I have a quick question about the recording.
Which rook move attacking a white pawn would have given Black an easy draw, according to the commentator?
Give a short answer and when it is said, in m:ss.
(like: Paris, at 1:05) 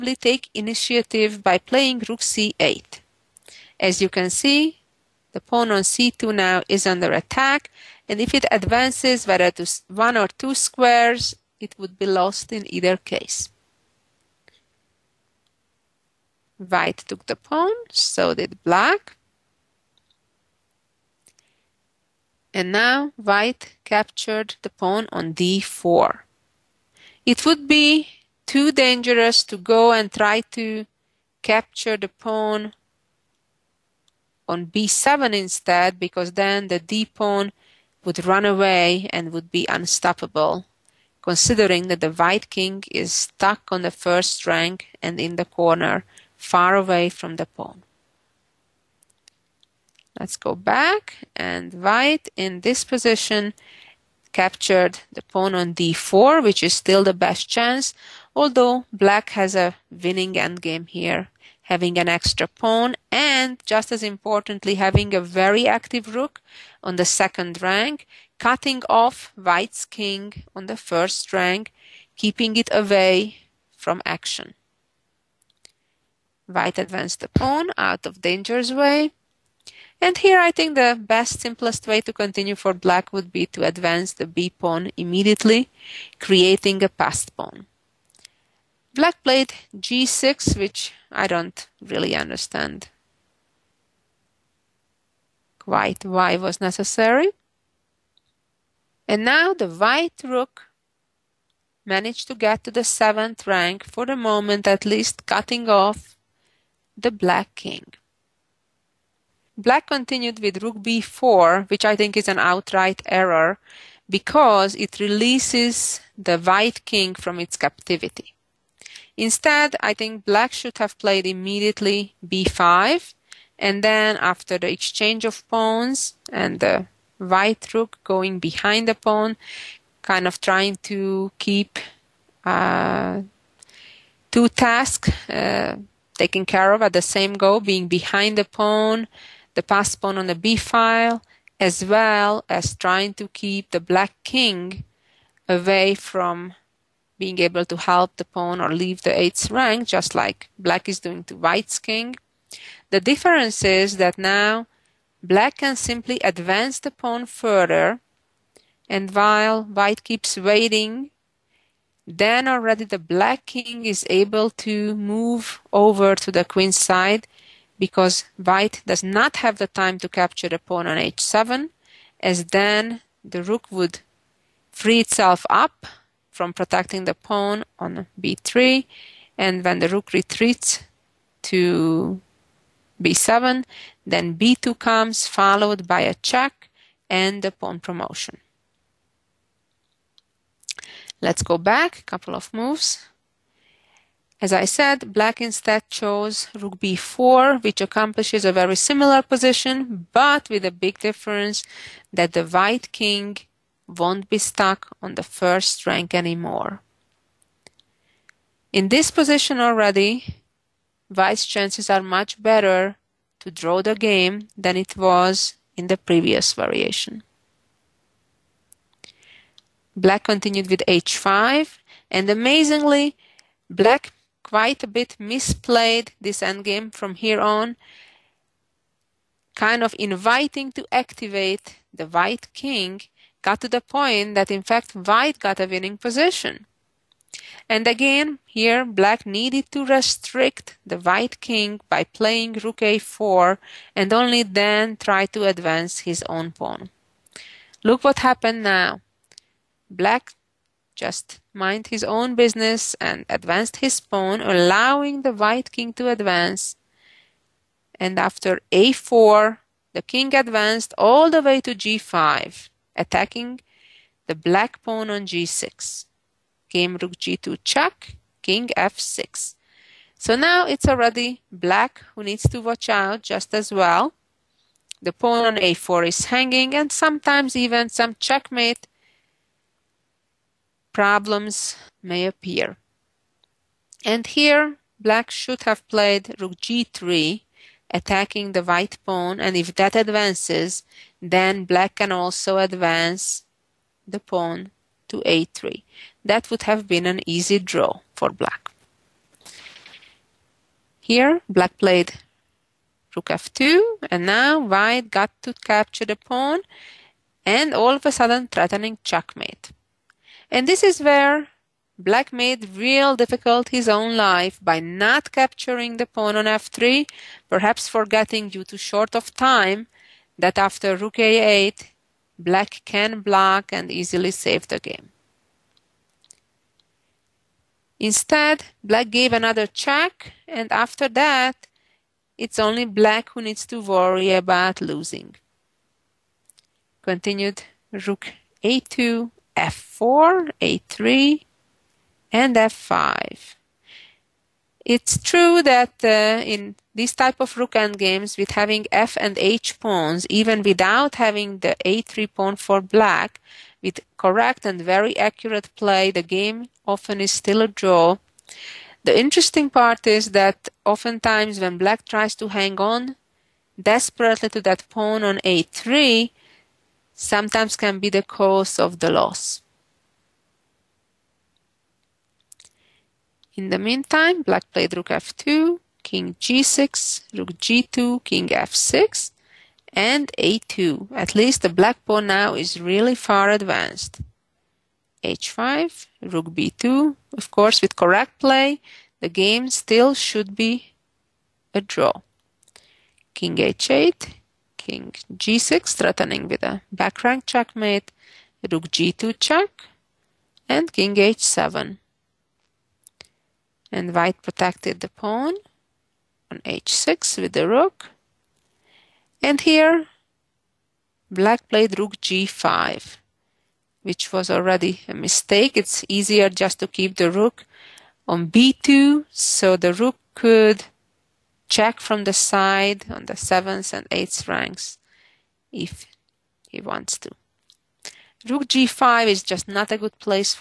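Rook g3, at 4:46.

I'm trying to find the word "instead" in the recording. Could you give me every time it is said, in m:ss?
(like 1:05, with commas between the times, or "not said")
0:35, 1:59, 3:15, 5:27.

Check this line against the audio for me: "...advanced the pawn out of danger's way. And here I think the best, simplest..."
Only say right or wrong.
right.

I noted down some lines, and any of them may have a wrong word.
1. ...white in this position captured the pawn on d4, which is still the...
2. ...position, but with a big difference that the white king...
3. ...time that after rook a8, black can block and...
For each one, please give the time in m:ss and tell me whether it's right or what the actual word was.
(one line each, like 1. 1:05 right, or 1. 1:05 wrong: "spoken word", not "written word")
1. 0:51 right
2. 3:19 right
3. 5:19 right.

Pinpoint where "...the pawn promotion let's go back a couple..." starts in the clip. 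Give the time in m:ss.
3:07.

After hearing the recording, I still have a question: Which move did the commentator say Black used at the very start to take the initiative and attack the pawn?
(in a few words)
Rook c8.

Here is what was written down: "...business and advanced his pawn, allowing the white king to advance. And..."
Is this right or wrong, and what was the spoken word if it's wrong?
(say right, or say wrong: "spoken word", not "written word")
right.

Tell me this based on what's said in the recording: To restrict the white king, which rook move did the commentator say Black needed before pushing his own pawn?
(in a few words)
Rook a4.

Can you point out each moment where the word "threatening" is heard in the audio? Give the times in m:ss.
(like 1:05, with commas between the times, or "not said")
5:08, 6:35.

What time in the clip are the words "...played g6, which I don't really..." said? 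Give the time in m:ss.
1:29.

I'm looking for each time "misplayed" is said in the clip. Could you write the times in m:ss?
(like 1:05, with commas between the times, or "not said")
3:45.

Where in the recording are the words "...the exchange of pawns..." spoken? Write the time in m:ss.
2:04.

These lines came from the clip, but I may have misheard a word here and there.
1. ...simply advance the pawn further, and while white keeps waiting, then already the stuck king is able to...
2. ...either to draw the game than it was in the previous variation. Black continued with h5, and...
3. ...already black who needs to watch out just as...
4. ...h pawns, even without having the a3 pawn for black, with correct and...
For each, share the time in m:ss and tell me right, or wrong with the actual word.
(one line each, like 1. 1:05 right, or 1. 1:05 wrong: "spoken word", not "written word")
1. 2:35 wrong: "black", not "stuck"
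2. 3:32 wrong: "better", not "either"
3. 4:30 right
4. 5:49 right.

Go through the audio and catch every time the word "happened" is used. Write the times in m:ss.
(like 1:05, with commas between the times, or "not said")
4:08.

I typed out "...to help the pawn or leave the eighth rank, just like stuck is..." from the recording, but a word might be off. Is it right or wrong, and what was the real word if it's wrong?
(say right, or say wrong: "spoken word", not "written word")
wrong: "black", not "stuck".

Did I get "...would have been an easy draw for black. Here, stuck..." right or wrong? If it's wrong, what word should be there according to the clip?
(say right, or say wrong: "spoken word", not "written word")
wrong: "black", not "stuck".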